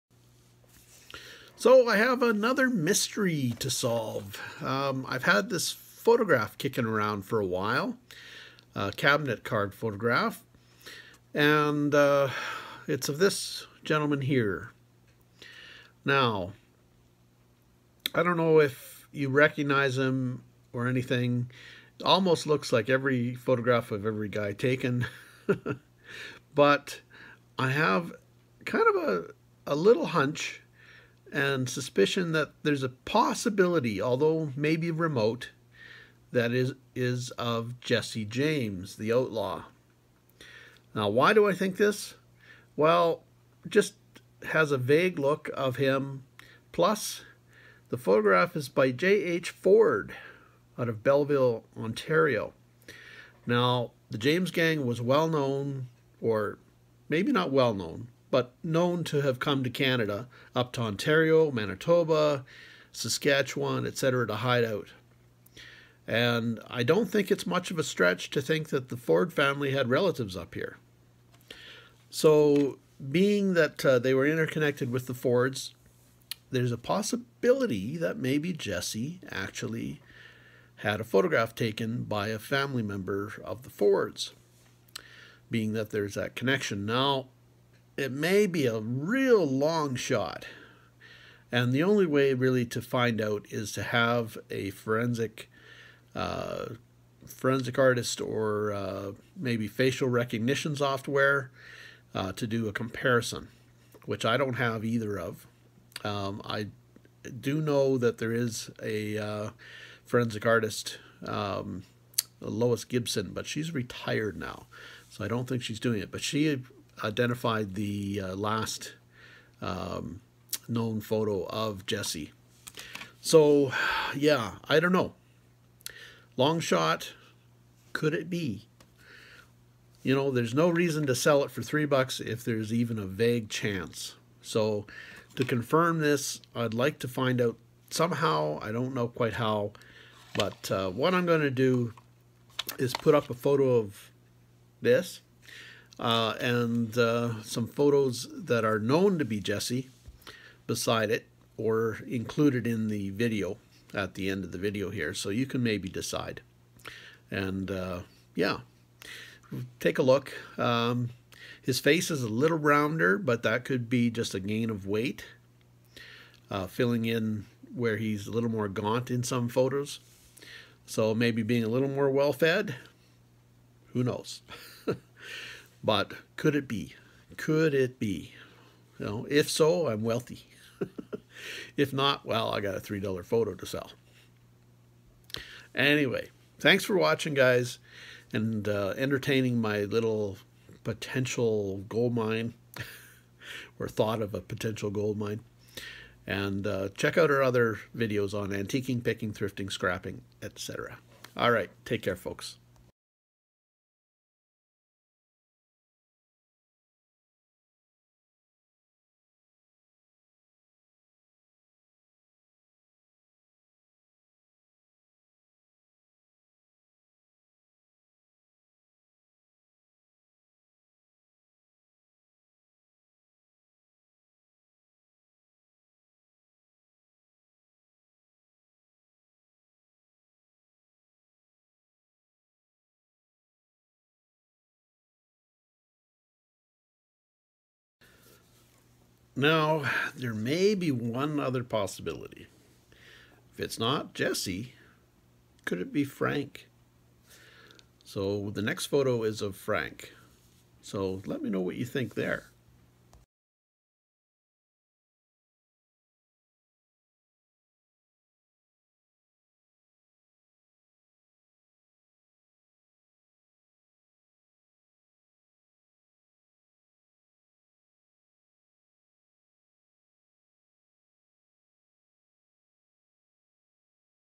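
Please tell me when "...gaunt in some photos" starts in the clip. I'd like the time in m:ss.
2:48.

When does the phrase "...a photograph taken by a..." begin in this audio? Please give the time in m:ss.
1:21.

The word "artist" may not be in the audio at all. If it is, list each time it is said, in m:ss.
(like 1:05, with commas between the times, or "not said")
1:37, 1:50.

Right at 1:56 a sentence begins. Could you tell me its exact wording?
But she identified the uh, last um, known photo of Jesse.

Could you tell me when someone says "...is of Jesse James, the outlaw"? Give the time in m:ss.
0:36.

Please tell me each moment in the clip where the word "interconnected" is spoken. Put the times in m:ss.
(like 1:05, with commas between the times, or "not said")
1:14.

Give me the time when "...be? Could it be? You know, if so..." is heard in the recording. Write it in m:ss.
2:56.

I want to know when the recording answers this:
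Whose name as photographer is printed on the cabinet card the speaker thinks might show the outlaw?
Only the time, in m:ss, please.
0:48.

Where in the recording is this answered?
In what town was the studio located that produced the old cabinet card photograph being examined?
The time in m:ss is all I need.
0:51.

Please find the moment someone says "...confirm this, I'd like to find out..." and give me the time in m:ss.
2:15.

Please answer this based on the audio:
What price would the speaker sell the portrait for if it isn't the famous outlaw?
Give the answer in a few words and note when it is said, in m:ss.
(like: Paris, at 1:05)
$3, at 3:02.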